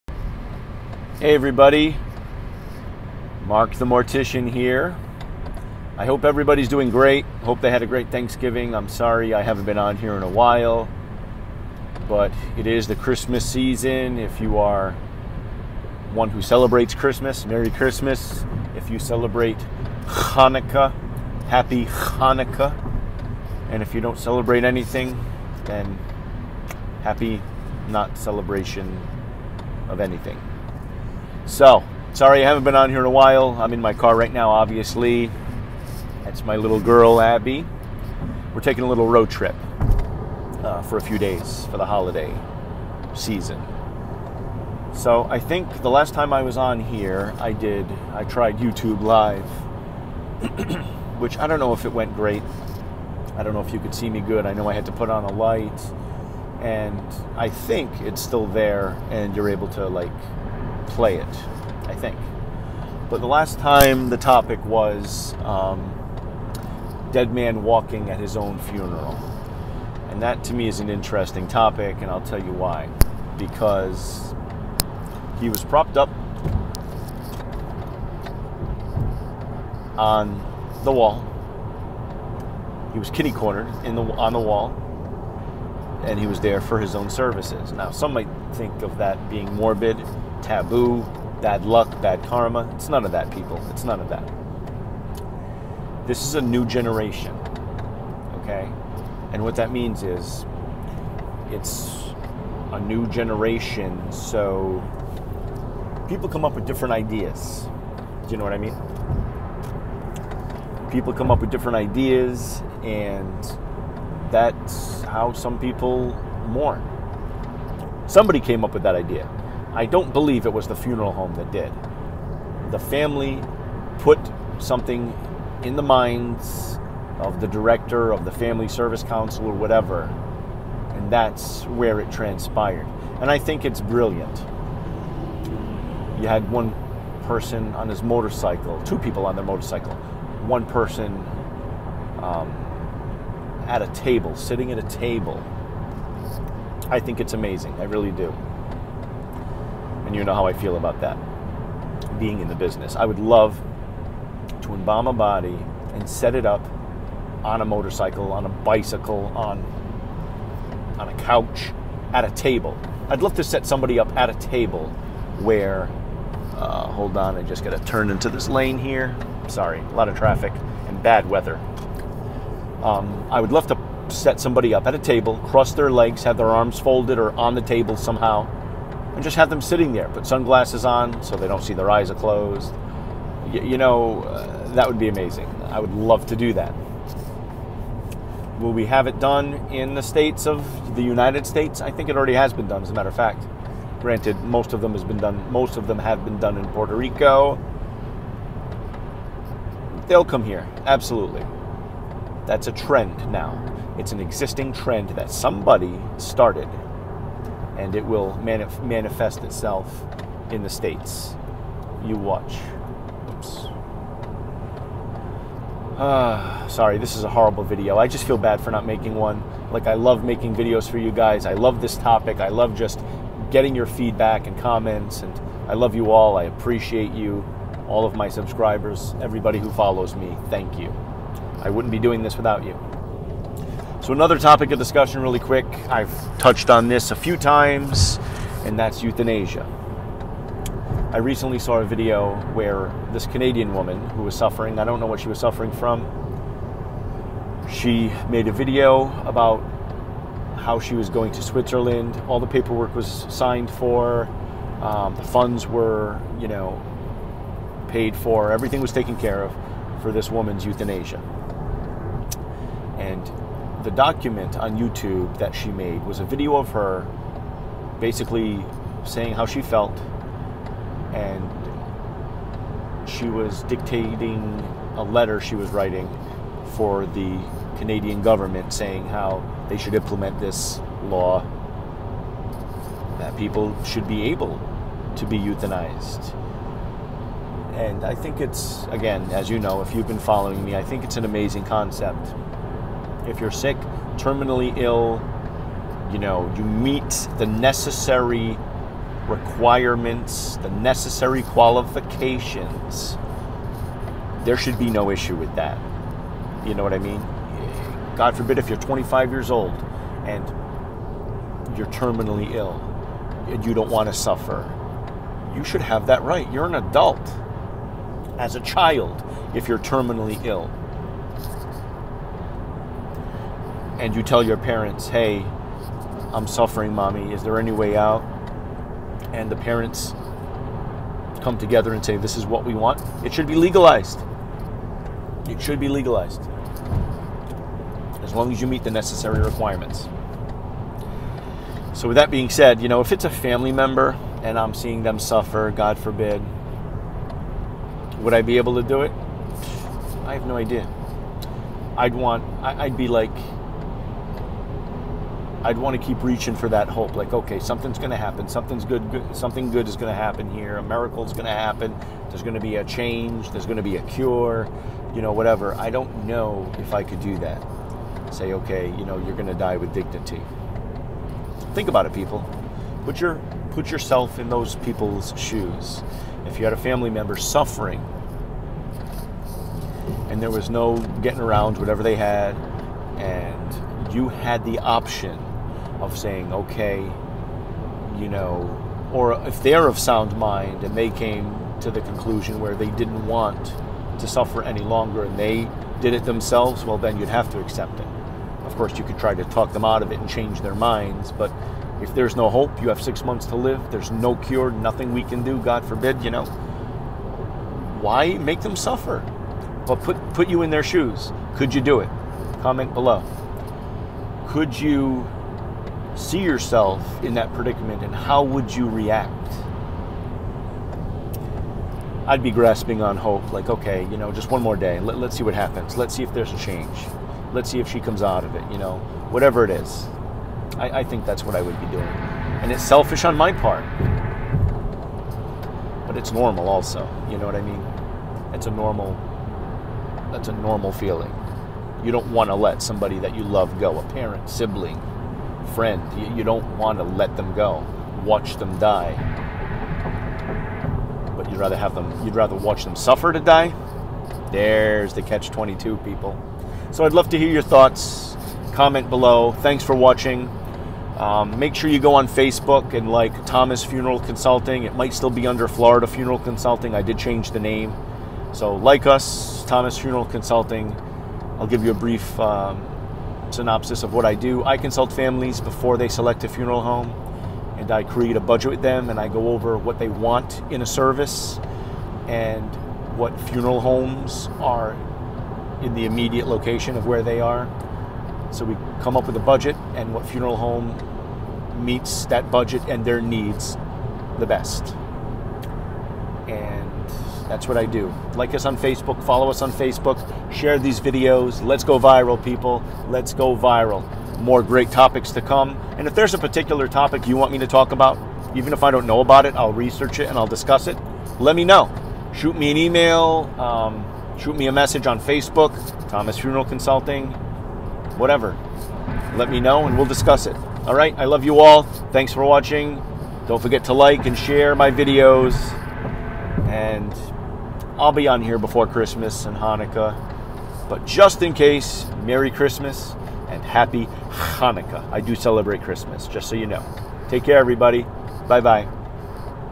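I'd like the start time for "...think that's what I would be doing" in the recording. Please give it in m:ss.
7:11.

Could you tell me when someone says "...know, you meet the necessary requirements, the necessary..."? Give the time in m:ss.
4:56.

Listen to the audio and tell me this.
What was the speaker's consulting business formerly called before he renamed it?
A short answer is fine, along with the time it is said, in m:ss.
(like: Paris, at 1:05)
Florida Funeral Consulting, at 7:45.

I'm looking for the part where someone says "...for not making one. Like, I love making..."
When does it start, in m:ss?
3:38.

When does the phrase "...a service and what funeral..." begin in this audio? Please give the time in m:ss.
8:00.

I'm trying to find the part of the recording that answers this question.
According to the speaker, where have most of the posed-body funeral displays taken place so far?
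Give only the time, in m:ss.
3:16.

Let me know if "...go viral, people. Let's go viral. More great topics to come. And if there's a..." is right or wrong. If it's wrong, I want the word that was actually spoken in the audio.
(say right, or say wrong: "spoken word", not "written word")
right.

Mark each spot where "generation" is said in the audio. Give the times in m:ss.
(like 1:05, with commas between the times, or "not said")
1:36, 1:43.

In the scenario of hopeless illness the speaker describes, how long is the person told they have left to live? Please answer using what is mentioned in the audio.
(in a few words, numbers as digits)
6 months.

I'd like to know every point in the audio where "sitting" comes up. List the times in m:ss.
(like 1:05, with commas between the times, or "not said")
2:24, 2:59.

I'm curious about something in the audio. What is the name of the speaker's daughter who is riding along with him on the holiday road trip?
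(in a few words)
Abby.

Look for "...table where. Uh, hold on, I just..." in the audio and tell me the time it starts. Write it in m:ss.
2:44.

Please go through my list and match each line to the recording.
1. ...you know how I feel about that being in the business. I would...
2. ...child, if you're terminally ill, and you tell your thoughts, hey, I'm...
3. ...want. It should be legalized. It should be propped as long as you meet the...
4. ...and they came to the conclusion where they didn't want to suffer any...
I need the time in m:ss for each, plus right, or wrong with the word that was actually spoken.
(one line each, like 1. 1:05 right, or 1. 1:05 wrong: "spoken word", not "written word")
1. 2:30 right
2. 5:18 wrong: "parents", not "thoughts"
3. 5:32 wrong: "legalized", not "propped"
4. 6:30 right.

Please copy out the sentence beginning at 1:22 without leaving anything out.
He was kitty cornered in the on the wall, and he was there for his own services.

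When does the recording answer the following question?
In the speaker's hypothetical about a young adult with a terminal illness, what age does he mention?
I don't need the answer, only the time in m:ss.
5:08.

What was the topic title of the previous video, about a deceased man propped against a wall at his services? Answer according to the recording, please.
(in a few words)
Dead Man Walking at His Own Funeral.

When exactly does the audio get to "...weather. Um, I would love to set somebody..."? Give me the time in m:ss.
2:51.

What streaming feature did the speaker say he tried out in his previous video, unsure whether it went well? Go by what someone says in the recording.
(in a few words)
YouTube Live.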